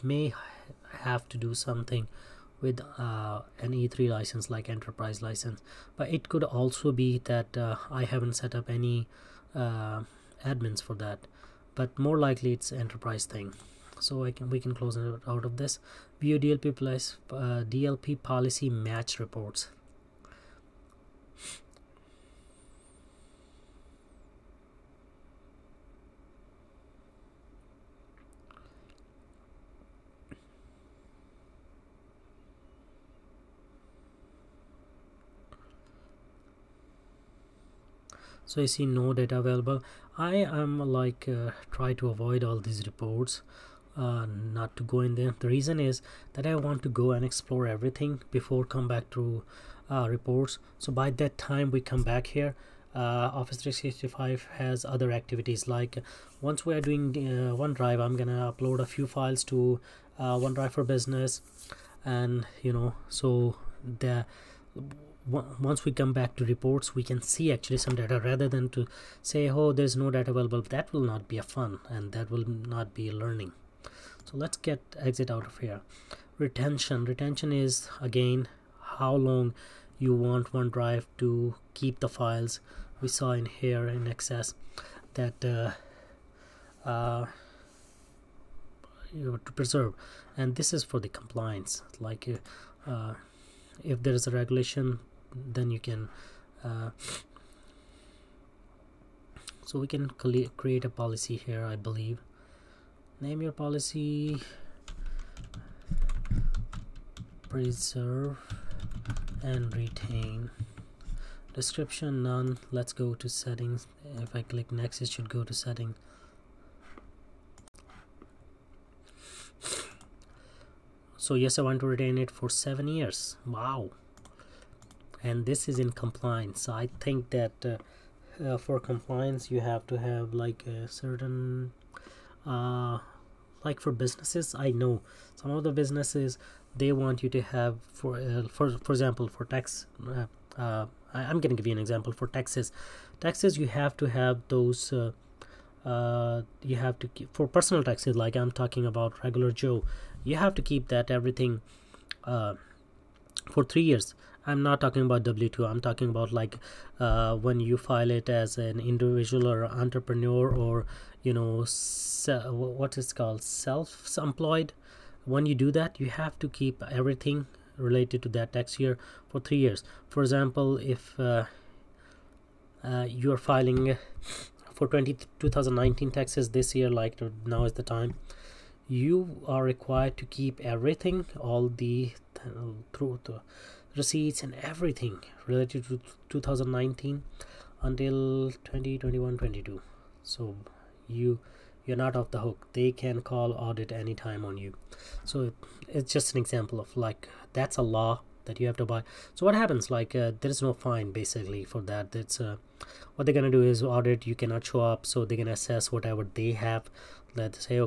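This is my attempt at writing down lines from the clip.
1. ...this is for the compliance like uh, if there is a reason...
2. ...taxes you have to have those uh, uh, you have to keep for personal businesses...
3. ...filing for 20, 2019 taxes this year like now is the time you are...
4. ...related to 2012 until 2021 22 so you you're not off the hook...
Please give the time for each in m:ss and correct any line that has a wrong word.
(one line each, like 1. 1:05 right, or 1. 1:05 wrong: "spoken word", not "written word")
1. 1:30 wrong: "regulation", not "reason"
2. 2:23 wrong: "taxes", not "businesses"
3. 2:53 right
4. 3:05 wrong: "2019", not "2012".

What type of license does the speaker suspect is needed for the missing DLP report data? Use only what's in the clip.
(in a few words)
E3 license.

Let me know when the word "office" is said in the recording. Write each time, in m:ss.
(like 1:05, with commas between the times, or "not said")
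0:53.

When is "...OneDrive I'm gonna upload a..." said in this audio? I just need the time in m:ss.
0:57.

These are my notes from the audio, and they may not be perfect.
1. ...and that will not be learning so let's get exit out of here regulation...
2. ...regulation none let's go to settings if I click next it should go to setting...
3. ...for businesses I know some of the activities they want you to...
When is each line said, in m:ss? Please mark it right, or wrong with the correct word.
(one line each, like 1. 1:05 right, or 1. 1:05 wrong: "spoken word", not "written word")
1. 1:11 wrong: "retention", not "regulation"
2. 1:51 wrong: "description", not "regulation"
3. 2:13 wrong: "businesses", not "activities".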